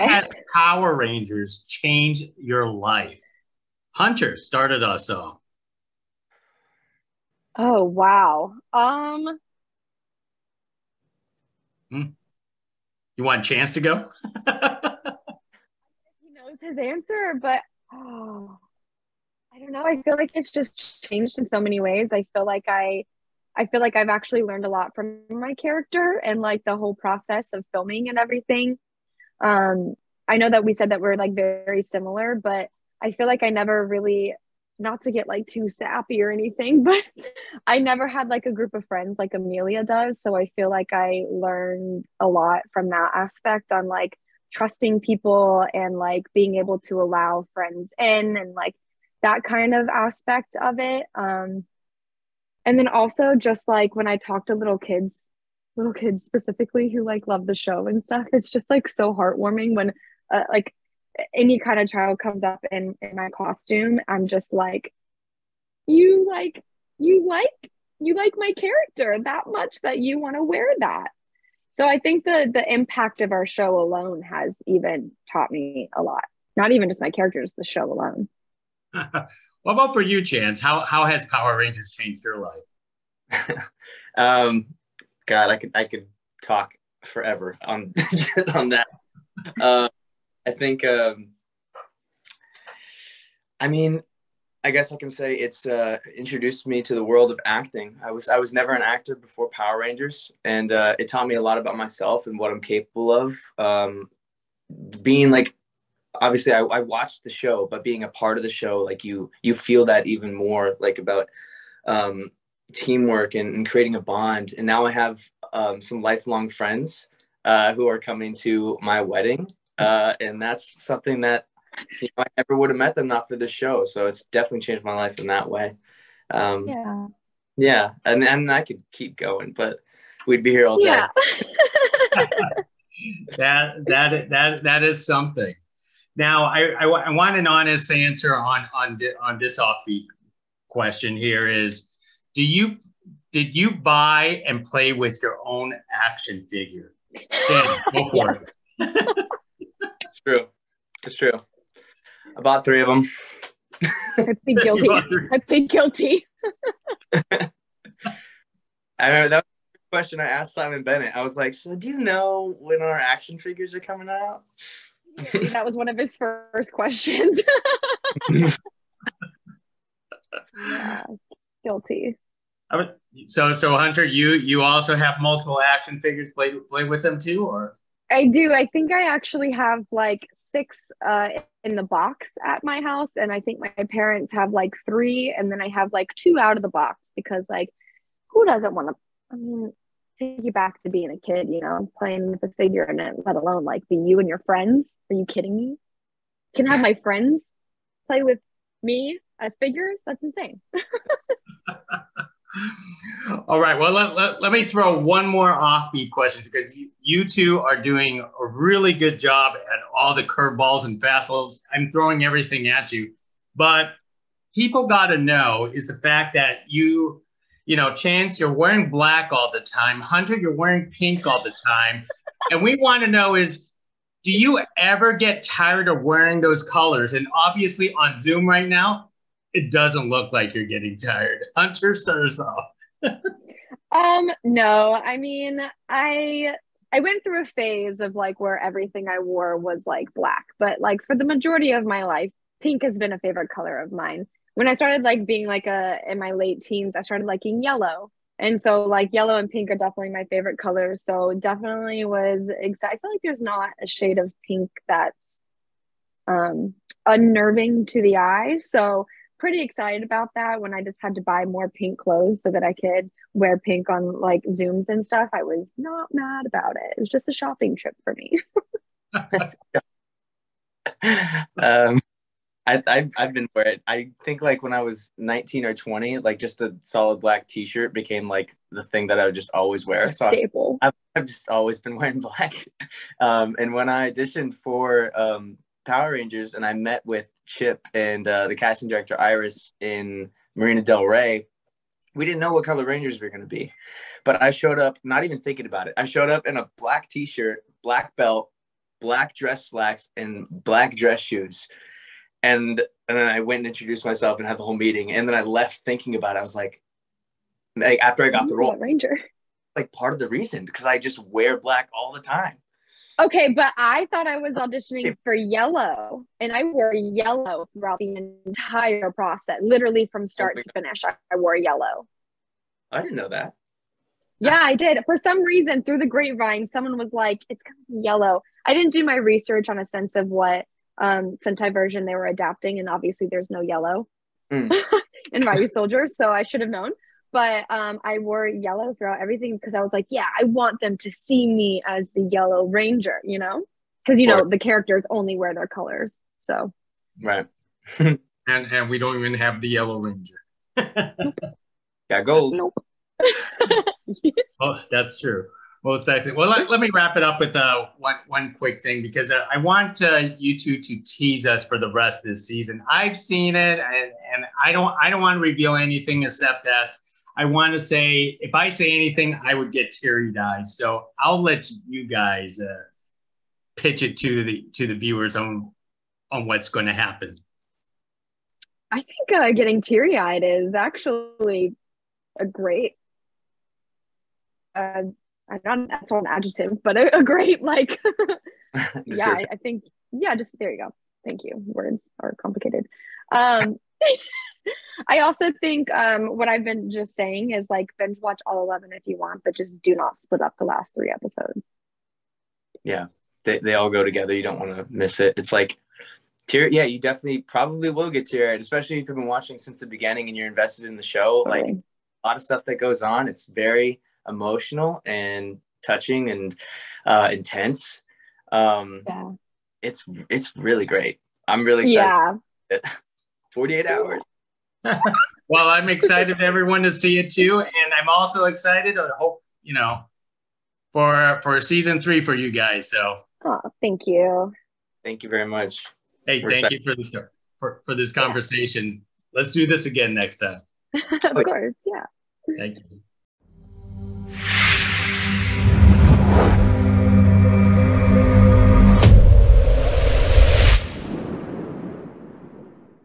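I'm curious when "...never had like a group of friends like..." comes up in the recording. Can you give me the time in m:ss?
0:37.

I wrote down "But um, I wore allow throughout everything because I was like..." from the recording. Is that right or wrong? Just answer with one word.
wrong.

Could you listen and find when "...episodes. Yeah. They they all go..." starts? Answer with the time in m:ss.
6:41.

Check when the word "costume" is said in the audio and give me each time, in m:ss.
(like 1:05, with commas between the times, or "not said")
1:03.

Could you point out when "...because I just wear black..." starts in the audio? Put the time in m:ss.
5:10.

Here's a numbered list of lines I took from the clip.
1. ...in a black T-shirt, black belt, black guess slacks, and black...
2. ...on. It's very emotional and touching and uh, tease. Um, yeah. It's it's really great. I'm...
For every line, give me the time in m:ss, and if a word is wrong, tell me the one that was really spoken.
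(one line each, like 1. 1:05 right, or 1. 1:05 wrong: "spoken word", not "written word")
1. 4:56 wrong: "dress", not "guess"
2. 6:53 wrong: "intense", not "tease".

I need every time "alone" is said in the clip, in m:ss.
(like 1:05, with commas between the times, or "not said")
1:13, 1:17, 3:13.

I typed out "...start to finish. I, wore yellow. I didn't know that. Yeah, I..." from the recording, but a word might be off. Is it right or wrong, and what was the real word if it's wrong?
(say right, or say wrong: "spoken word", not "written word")
right.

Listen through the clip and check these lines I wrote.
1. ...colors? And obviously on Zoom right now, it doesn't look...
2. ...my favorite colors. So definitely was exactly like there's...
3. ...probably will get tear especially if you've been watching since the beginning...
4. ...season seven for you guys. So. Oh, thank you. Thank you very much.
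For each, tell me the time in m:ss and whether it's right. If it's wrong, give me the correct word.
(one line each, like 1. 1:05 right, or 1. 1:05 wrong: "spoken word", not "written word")
1. 3:46 right
2. 4:10 right
3. 6:47 right
4. 7:11 wrong: "three", not "seven".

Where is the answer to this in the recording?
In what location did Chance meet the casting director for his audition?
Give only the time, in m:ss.
4:50.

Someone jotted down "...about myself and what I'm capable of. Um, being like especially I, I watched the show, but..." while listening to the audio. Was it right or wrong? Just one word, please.
wrong.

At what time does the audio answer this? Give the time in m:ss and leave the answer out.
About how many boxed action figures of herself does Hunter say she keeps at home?
3:00.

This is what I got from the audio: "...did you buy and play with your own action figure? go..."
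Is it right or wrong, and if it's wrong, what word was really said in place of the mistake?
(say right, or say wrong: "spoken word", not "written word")
right.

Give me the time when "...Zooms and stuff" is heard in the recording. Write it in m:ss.
4:24.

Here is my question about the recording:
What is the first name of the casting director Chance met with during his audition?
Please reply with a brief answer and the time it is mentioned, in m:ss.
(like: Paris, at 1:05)
Iris, at 4:49.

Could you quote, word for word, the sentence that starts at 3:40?
Hunter, you're wearing pink all the time.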